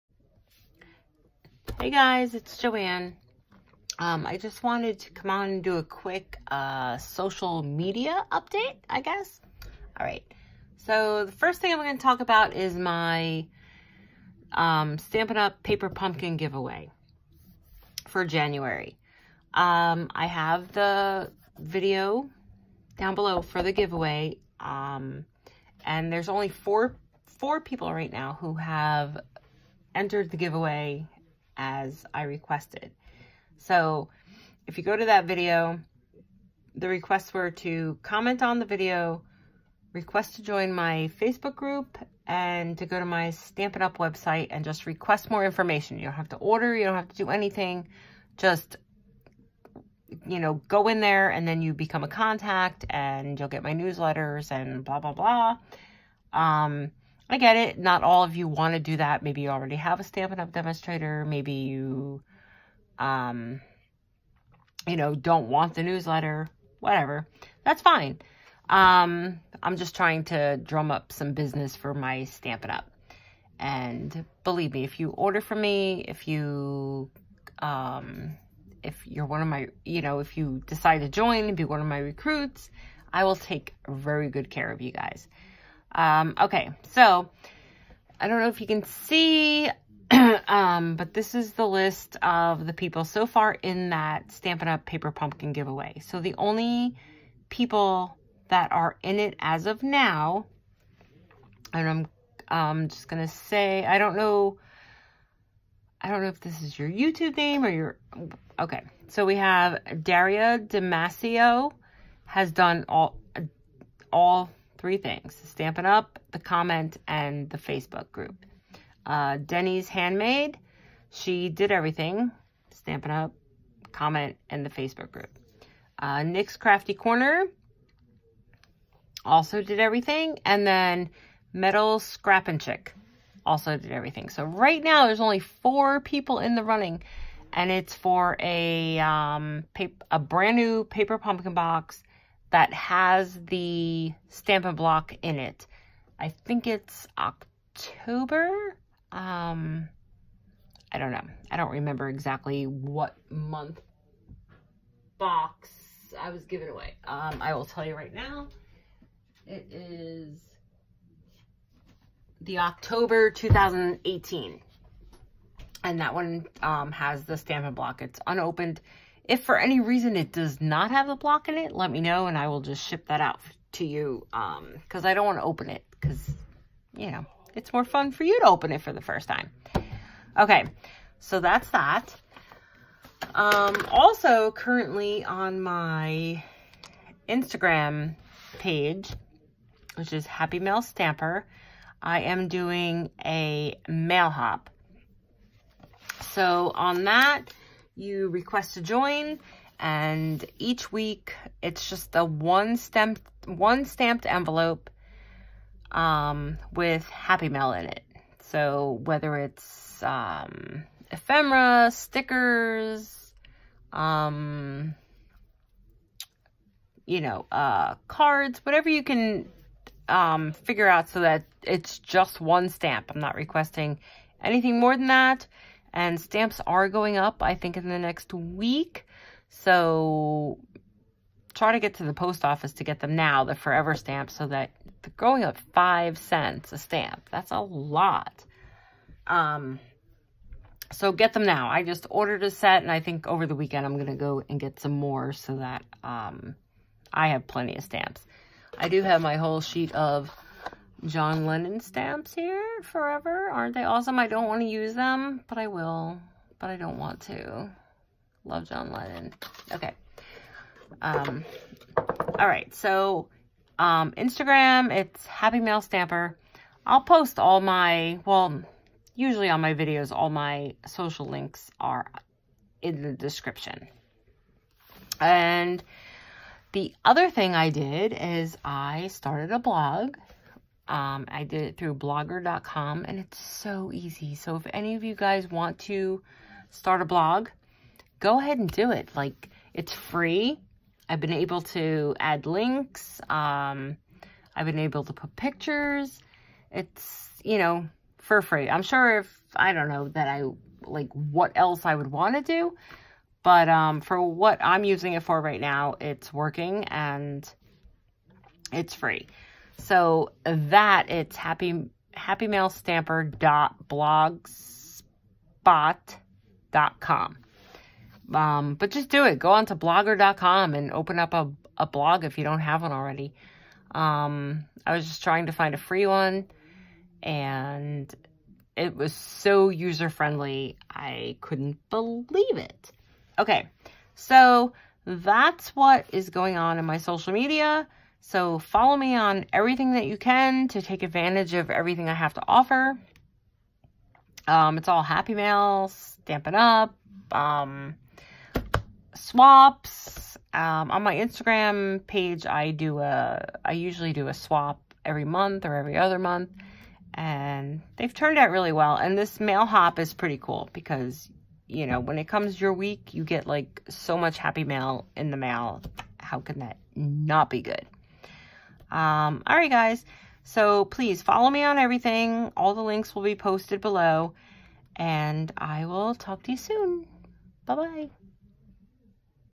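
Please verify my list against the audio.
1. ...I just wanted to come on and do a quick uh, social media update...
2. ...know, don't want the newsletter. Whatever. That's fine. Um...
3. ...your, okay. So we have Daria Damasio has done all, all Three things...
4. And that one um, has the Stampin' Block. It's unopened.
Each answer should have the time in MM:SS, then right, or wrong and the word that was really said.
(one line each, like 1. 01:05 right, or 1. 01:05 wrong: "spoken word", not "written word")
1. 00:04 right
2. 01:04 right
3. 01:47 right
4. 02:45 right.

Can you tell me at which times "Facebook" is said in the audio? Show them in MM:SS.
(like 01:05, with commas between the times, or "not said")
00:41, 01:57, 02:04.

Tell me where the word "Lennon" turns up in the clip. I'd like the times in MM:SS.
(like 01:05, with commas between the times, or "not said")
04:11, 04:18.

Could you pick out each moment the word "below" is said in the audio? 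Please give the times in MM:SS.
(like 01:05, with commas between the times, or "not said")
00:23, 06:13.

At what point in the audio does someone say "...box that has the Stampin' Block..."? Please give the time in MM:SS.
02:21.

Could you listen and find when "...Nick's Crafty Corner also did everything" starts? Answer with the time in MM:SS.
02:06.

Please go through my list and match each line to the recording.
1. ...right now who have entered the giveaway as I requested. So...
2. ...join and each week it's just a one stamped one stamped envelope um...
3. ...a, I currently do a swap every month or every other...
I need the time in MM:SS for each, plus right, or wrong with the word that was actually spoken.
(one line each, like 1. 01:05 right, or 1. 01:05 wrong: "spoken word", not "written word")
1. 00:27 right
2. 03:18 right
3. 05:52 wrong: "usually", not "currently".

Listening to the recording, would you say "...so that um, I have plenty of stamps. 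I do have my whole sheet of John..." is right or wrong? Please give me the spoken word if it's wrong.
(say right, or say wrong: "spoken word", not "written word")
right.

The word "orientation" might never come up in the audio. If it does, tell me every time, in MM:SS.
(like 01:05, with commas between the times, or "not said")
not said.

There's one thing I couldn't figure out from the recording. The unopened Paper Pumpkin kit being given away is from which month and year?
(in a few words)
October 2018.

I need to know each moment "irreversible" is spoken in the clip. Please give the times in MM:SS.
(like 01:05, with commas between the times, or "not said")
not said.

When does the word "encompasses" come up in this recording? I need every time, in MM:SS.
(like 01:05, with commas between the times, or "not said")
not said.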